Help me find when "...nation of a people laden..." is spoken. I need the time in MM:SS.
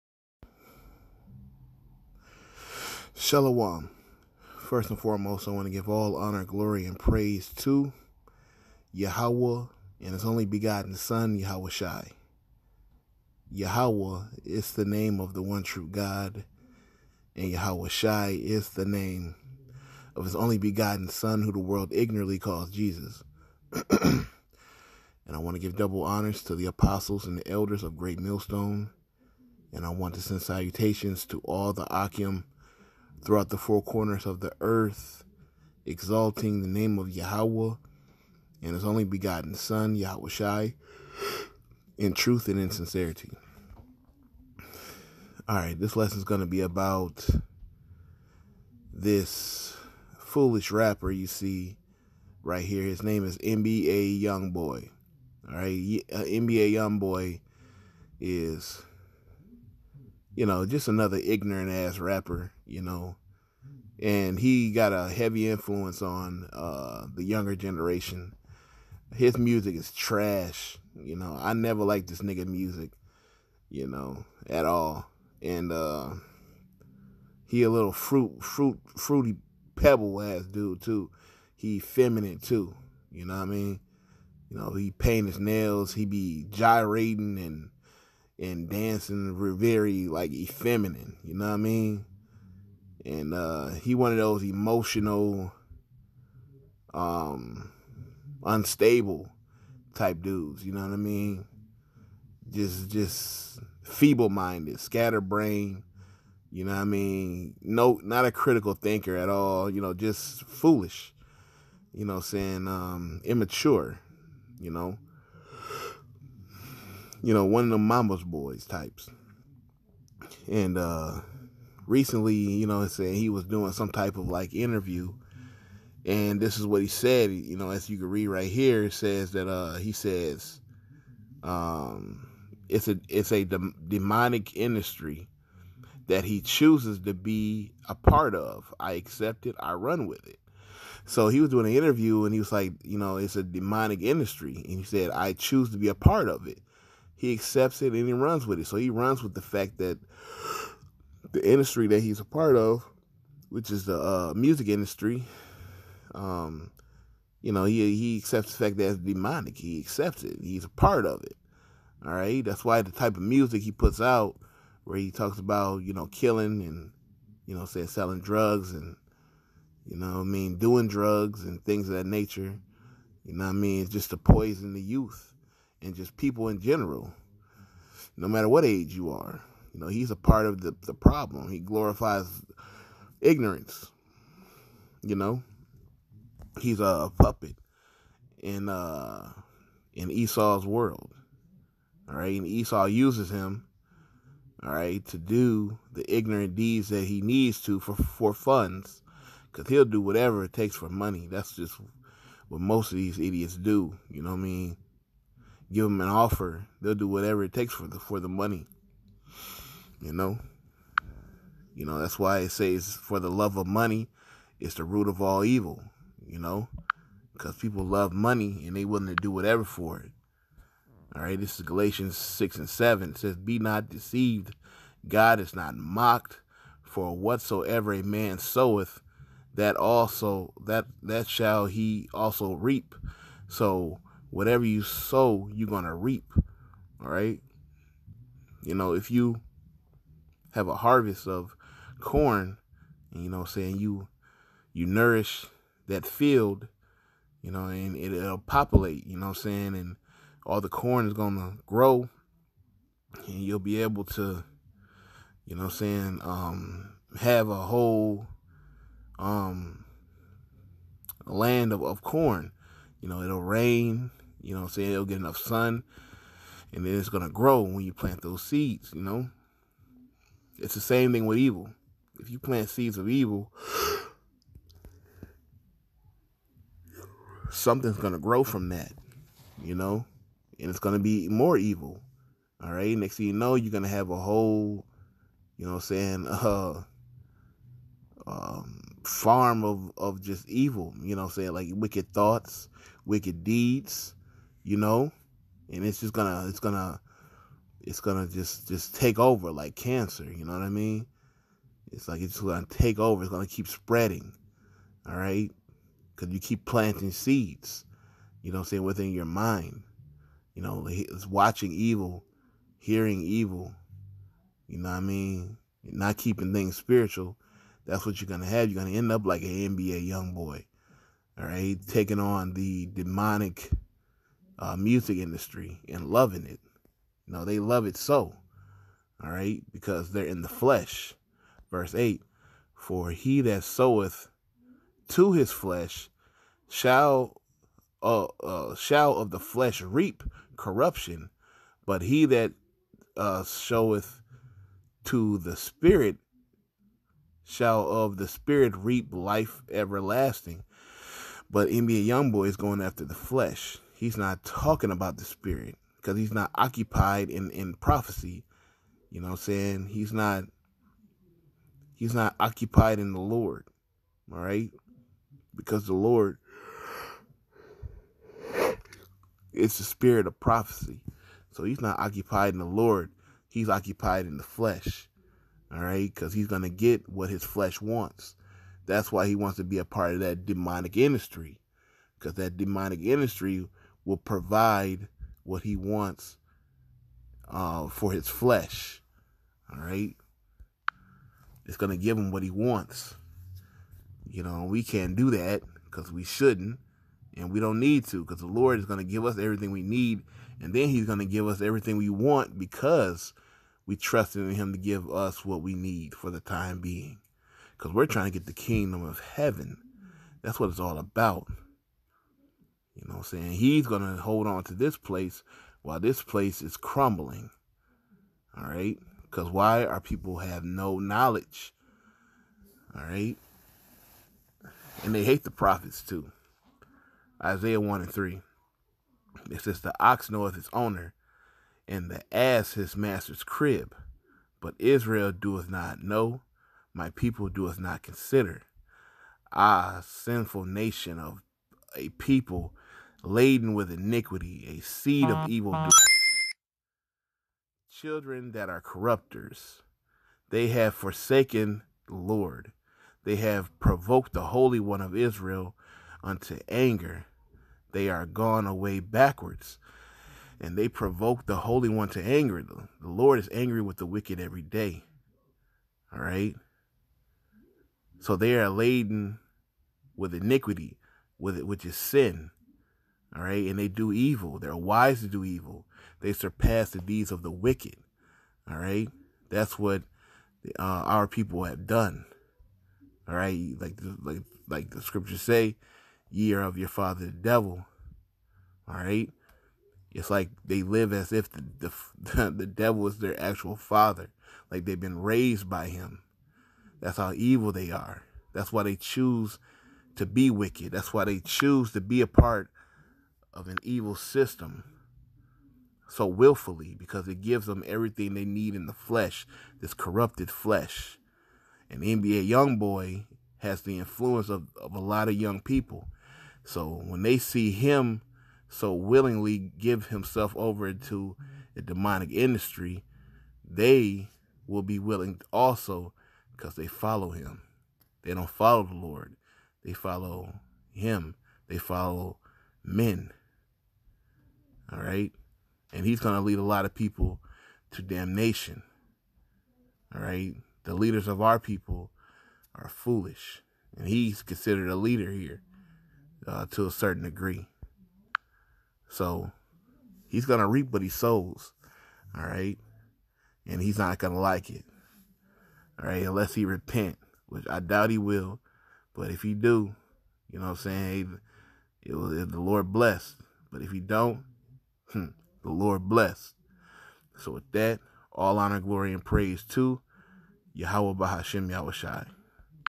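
07:20.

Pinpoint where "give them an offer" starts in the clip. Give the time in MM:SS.
03:25.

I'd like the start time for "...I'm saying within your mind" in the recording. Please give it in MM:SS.
05:08.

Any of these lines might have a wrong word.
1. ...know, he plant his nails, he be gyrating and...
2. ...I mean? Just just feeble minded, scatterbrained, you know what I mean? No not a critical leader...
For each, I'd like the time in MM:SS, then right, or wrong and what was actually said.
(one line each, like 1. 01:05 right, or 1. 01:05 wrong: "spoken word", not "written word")
1. 01:24 wrong: "paint", not "plant"
2. 01:40 wrong: "thinker", not "leader".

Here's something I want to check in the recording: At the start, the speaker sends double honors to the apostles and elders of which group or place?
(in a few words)
Great Millstone.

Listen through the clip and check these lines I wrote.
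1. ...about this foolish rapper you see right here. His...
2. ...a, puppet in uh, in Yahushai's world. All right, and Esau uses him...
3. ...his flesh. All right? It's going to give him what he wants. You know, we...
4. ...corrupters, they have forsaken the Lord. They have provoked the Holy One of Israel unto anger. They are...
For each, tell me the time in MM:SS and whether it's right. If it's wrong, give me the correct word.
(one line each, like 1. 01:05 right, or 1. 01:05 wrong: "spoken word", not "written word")
1. 00:46 right
2. 03:06 wrong: "Esau", not "Yahushai"
3. 06:28 right
4. 07:28 right.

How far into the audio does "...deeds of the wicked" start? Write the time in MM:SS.
07:56.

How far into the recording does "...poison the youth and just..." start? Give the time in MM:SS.
02:54.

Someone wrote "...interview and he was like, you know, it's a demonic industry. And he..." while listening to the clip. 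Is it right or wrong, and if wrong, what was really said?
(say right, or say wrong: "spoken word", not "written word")
right.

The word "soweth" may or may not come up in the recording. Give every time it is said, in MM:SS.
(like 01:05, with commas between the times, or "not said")
03:48, 05:33.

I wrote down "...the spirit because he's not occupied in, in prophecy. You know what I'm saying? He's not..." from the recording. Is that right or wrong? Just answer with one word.
right.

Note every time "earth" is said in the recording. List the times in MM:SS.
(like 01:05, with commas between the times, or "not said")
00:34.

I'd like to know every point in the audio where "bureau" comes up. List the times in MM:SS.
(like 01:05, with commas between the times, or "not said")
not said.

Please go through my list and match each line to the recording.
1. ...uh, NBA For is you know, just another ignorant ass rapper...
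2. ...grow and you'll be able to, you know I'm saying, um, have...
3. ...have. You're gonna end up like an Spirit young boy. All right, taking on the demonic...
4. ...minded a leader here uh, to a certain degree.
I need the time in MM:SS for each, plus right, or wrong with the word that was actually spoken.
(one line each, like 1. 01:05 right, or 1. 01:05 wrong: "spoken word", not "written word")
1. 00:56 wrong: "YoungBoy", not "For"
2. 04:11 right
3. 05:18 wrong: "NBA", not "Spirit"
4. 09:04 wrong: "considered", not "minded".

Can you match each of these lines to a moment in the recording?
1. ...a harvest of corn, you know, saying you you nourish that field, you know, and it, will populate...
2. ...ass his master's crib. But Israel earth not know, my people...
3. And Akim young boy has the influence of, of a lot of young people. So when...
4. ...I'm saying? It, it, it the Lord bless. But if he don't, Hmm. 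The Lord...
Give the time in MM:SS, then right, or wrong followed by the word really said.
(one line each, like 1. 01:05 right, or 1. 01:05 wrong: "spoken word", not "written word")
1. 04:00 right
2. 07:12 wrong: "doeth", not "earth"
3. 08:31 wrong: "NBA", not "Akim"
4. 09:20 right.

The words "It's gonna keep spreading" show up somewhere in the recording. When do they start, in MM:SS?
05:03.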